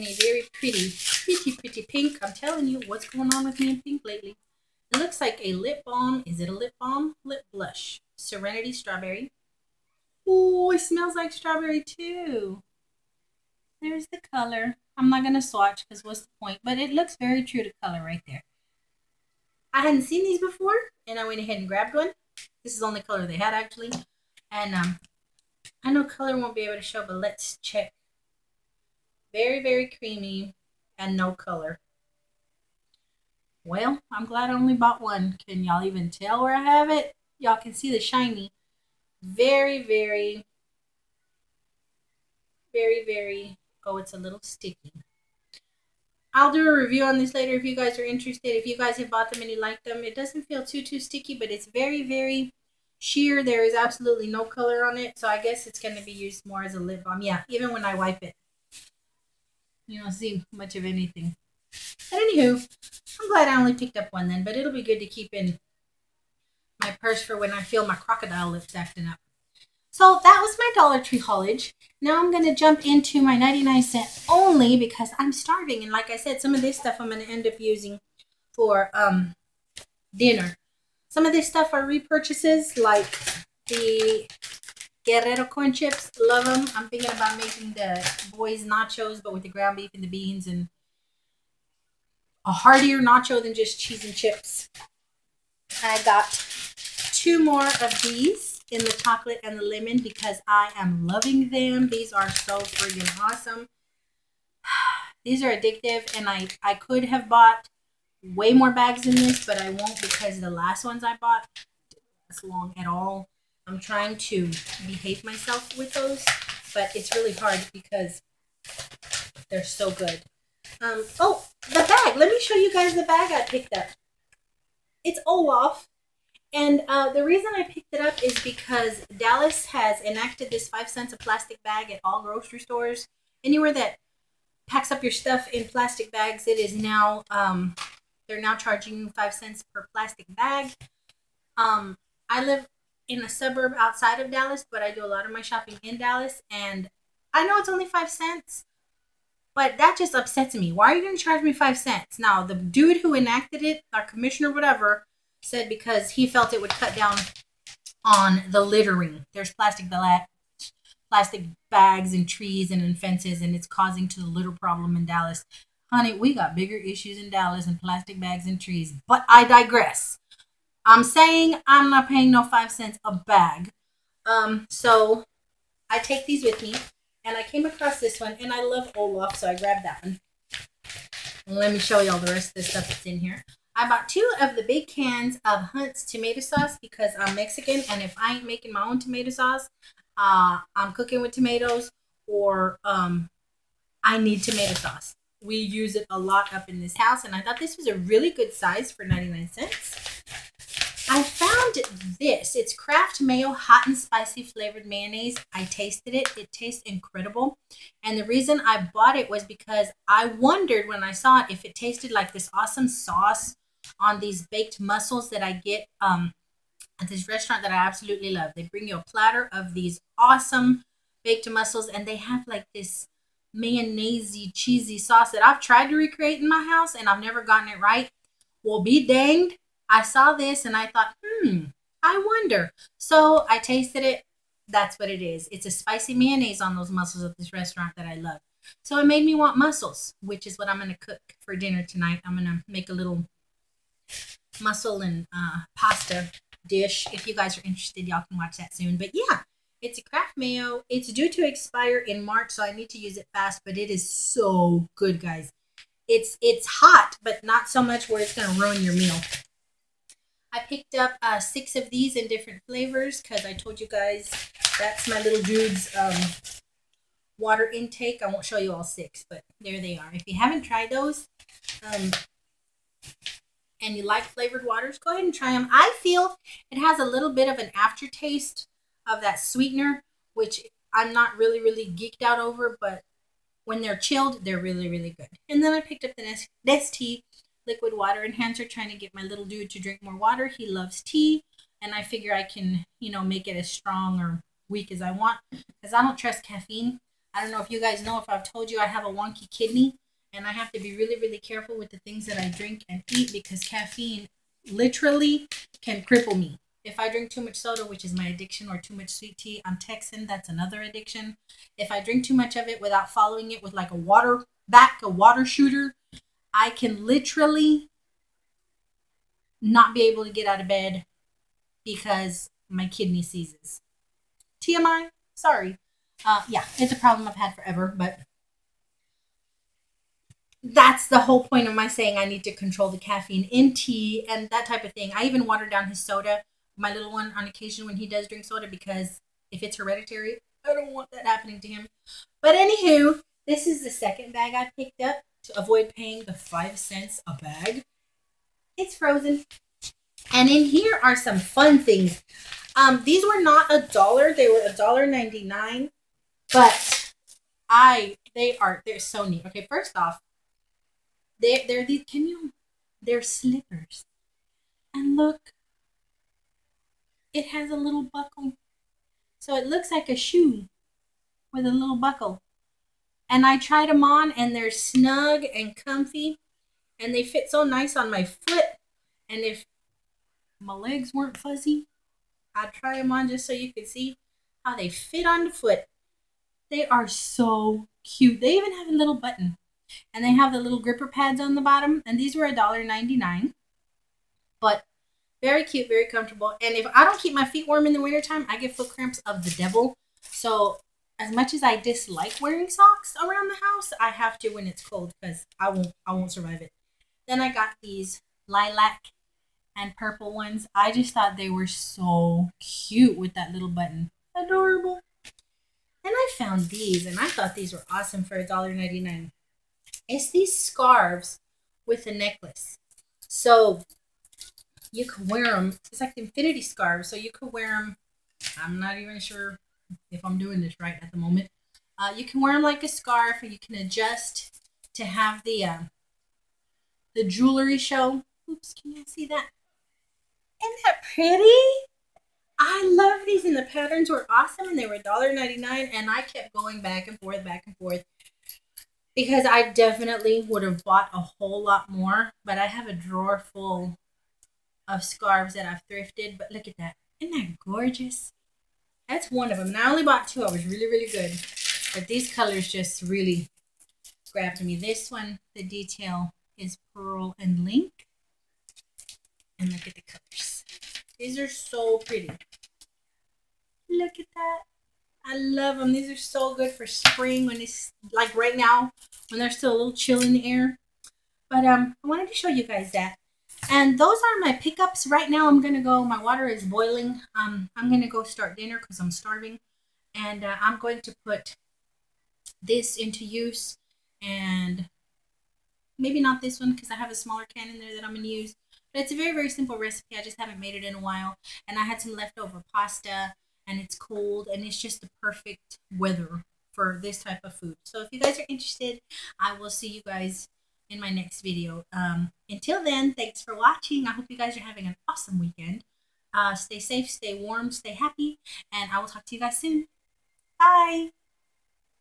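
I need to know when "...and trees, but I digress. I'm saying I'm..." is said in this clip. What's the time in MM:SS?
02:48.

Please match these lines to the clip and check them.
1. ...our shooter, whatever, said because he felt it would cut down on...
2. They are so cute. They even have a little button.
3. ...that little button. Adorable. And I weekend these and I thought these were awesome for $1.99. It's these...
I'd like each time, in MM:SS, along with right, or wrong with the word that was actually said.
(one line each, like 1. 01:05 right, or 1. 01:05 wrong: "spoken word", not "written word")
1. 02:33 wrong: "commissioner", not "shooter"
2. 06:26 right
3. 06:53 wrong: "found", not "weekend".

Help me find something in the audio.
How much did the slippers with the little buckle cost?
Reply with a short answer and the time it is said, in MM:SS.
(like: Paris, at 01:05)
$1.99, at 05:54.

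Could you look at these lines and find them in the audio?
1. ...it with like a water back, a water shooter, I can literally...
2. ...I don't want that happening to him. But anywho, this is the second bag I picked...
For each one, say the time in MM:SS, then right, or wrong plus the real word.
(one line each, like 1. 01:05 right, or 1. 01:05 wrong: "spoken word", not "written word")
1. 05:13 right
2. 05:40 right.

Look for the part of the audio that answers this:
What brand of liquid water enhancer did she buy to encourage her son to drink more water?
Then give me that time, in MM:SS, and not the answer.
04:46.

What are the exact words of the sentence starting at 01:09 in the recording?
So that was my Dollar Tree haulage.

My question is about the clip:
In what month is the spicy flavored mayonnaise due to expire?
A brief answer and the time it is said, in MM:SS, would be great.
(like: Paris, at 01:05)
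March, at 04:12.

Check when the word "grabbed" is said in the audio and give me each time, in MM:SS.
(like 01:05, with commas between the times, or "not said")
00:21, 02:59, 07:44.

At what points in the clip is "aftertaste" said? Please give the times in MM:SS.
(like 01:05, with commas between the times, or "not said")
04:37.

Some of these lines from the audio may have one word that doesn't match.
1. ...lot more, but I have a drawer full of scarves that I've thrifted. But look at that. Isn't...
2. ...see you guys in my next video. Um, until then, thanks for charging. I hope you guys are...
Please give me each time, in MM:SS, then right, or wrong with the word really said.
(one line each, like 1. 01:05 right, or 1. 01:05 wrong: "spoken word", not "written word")
1. 07:31 right
2. 08:29 wrong: "watching", not "charging".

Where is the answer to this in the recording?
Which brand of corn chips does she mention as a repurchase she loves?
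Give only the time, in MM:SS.
01:25.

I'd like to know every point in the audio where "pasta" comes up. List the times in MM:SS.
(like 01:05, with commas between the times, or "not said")
04:05, 08:22.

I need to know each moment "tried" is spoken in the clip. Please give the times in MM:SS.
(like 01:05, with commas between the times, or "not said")
03:45, 04:30, 06:13.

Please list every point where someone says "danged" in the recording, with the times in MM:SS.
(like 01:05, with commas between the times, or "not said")
03:49.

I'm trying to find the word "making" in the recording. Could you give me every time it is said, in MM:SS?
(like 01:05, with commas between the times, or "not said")
01:27, 03:08.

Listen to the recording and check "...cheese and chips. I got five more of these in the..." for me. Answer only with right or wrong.
wrong.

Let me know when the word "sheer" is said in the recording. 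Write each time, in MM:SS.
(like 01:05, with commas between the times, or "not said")
00:52.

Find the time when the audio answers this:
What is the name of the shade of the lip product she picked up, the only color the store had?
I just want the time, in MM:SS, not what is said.
00:08.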